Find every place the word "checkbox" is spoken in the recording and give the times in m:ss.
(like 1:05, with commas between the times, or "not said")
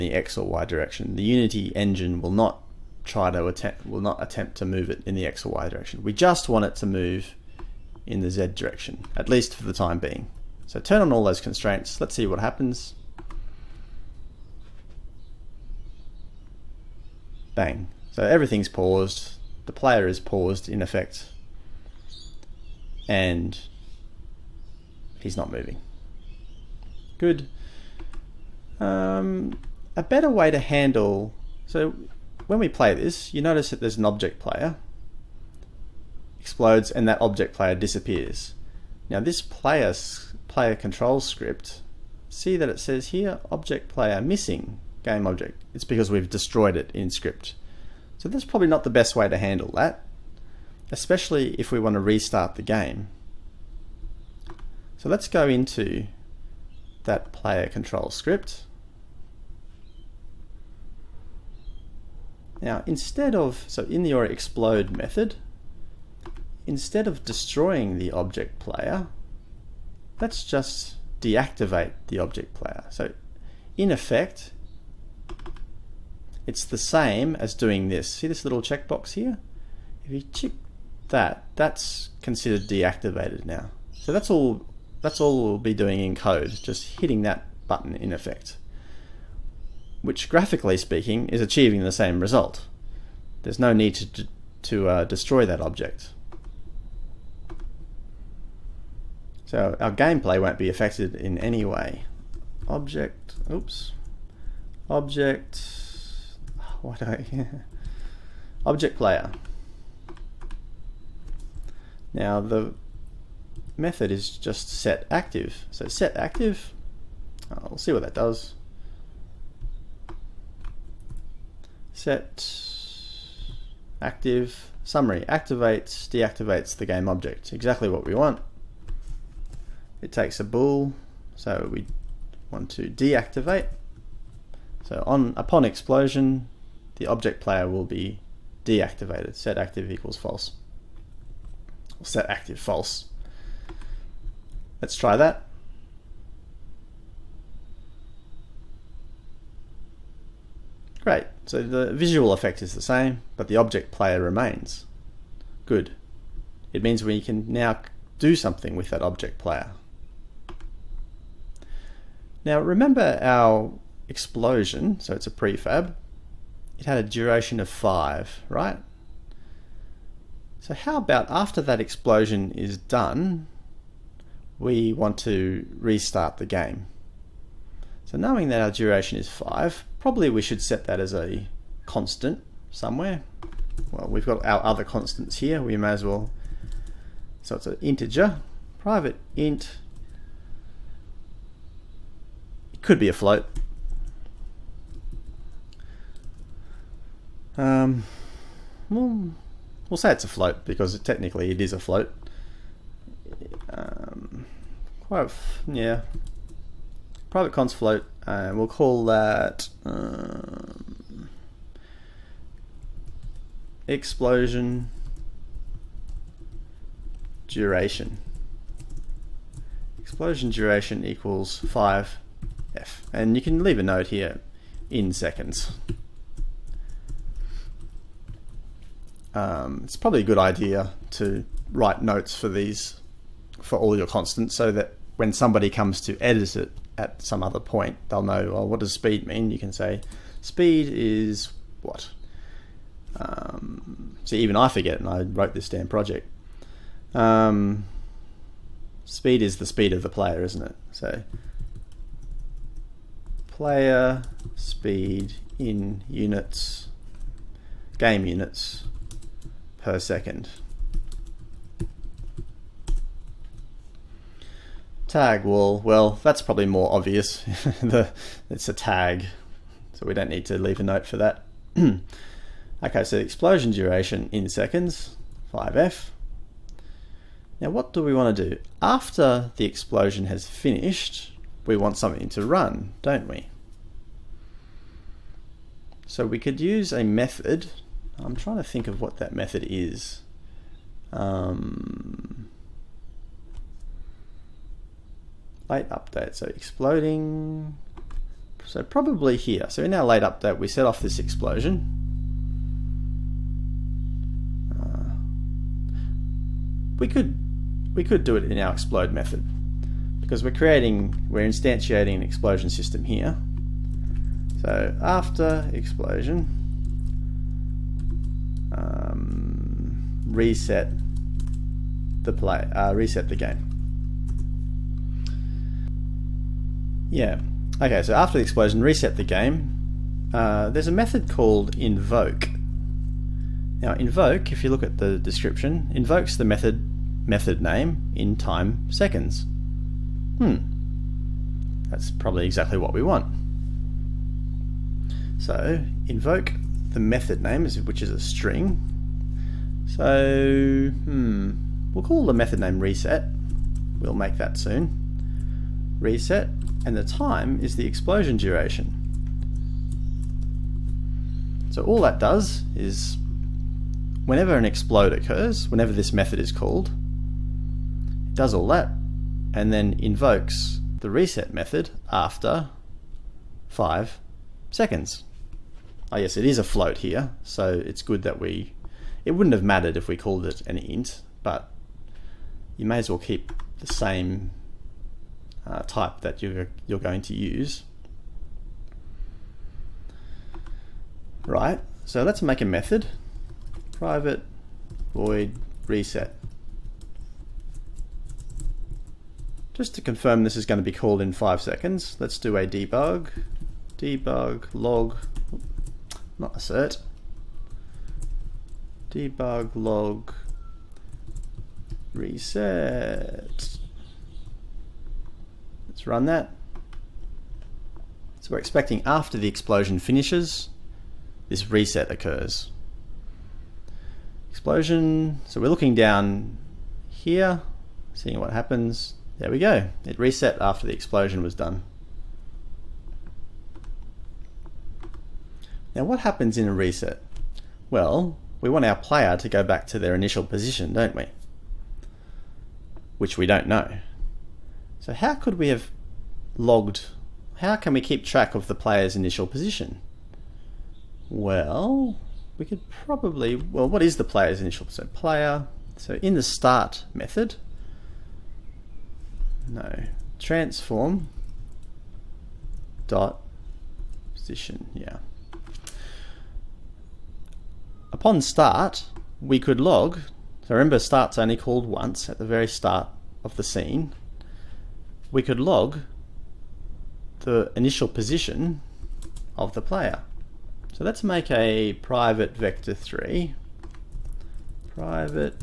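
1:18.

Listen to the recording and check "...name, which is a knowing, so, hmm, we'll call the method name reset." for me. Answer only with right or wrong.
wrong.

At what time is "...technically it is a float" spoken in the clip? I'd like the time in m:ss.
3:20.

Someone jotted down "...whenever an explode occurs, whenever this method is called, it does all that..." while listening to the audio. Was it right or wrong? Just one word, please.
right.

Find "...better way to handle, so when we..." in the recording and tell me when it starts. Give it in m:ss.
0:30.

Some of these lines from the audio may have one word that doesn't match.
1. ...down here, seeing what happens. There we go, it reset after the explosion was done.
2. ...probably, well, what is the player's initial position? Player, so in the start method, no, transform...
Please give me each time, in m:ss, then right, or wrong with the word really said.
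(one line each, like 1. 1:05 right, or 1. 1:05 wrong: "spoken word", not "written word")
1. 7:05 right
2. 7:33 right.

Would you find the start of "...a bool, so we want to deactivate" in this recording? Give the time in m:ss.
2:10.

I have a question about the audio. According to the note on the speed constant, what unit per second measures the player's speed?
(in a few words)
game units.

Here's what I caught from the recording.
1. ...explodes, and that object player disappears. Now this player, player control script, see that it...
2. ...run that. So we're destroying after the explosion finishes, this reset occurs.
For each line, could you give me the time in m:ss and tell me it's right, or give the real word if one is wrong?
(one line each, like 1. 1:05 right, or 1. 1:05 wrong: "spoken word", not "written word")
1. 0:36 right
2. 6:56 wrong: "expecting", not "destroying".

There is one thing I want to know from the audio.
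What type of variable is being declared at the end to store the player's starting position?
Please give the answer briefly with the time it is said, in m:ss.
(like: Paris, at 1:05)
Vector3, at 8:02.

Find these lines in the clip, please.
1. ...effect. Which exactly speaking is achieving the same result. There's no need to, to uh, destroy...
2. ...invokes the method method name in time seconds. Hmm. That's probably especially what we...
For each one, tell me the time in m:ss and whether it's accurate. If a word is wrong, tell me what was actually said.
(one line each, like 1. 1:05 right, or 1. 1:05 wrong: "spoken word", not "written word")
1. 1:28 wrong: "graphically", not "exactly"
2. 5:35 wrong: "exactly", not "especially".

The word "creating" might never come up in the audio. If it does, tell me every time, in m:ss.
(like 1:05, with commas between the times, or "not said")
5:10.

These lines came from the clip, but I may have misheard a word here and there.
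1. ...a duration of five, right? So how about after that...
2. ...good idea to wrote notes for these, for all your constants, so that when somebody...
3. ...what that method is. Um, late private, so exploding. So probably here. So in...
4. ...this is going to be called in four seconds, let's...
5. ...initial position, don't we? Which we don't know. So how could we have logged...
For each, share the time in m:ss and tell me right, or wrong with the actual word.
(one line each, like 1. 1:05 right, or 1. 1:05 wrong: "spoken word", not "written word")
1. 2:46 right
2. 3:50 wrong: "write", not "wrote"
3. 4:48 wrong: "update", not "private"
4. 6:40 wrong: "five", not "four"
5. 7:20 right.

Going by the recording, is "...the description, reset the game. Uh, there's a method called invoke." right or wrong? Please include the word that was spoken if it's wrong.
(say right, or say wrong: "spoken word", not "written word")
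wrong: "explosion", not "description".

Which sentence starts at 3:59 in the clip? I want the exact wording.
You can say, speed is what?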